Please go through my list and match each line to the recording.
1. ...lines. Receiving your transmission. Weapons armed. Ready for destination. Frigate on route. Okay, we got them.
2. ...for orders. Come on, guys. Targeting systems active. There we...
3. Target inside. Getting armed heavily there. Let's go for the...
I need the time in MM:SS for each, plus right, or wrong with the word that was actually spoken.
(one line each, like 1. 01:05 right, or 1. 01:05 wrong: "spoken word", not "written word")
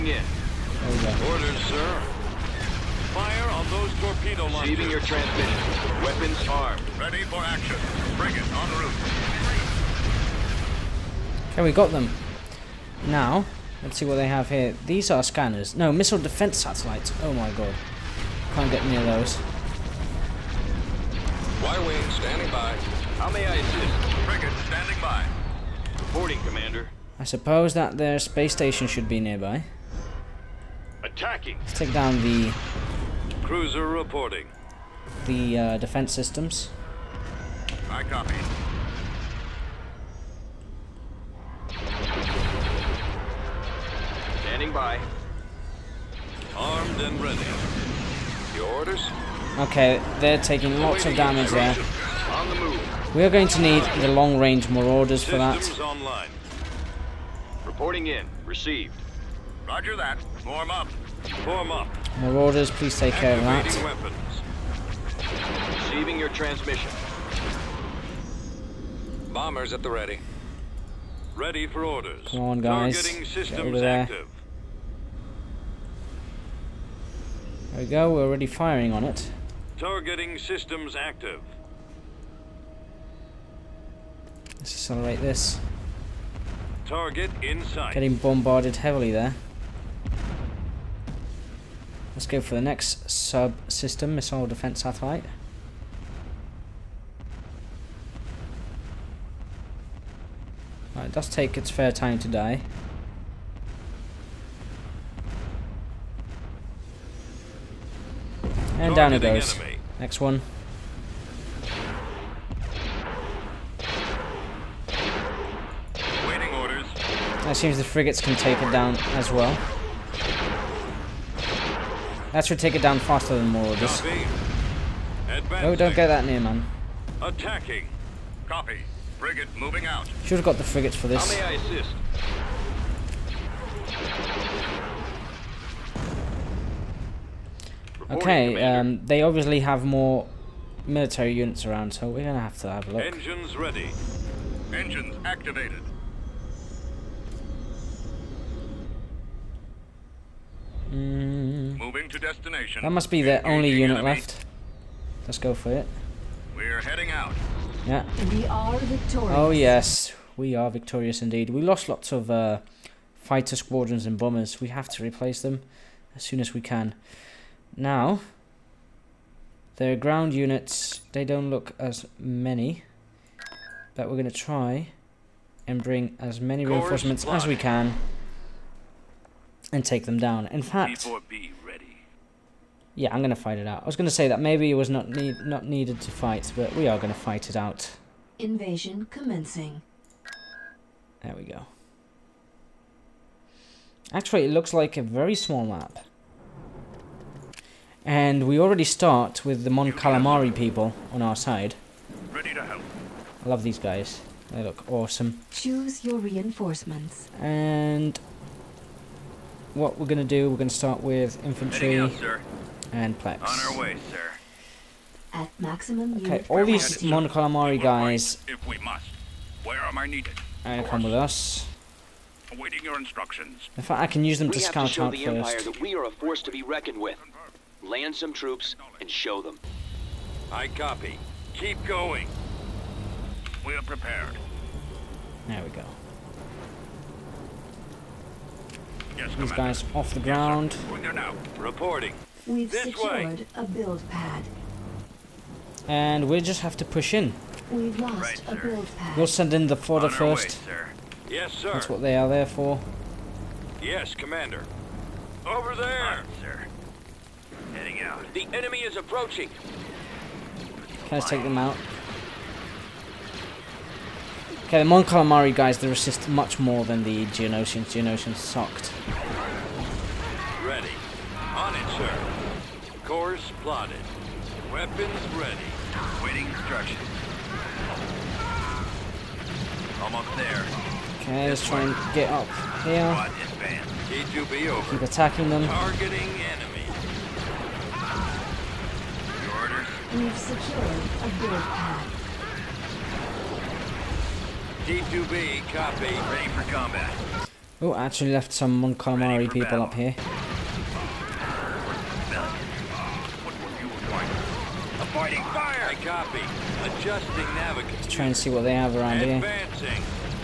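1. 00:04 wrong: "action", not "destination"
2. 01:11 right
3. 01:26 wrong: "bombarded", not "armed".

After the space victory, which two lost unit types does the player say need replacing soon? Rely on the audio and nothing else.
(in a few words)
Fighter squadrons and bombers.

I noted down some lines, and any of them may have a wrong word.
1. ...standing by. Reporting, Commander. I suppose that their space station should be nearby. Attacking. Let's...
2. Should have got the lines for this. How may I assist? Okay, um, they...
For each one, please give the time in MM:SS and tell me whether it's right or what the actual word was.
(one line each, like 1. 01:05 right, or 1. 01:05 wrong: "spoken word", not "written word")
1. 00:24 right
2. 02:10 wrong: "frigates", not "lines".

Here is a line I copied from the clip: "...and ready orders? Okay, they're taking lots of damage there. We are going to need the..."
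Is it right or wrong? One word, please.
right.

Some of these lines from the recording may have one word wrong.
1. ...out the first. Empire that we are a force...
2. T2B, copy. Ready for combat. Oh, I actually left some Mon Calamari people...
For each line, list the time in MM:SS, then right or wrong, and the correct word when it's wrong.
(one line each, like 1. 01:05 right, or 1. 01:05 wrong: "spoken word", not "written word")
1. 03:45 right
2. 04:54 right.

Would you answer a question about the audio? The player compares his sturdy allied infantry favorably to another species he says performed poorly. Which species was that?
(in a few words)
Geonosians.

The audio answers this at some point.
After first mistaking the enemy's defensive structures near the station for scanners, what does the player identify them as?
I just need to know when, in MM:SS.
00:15.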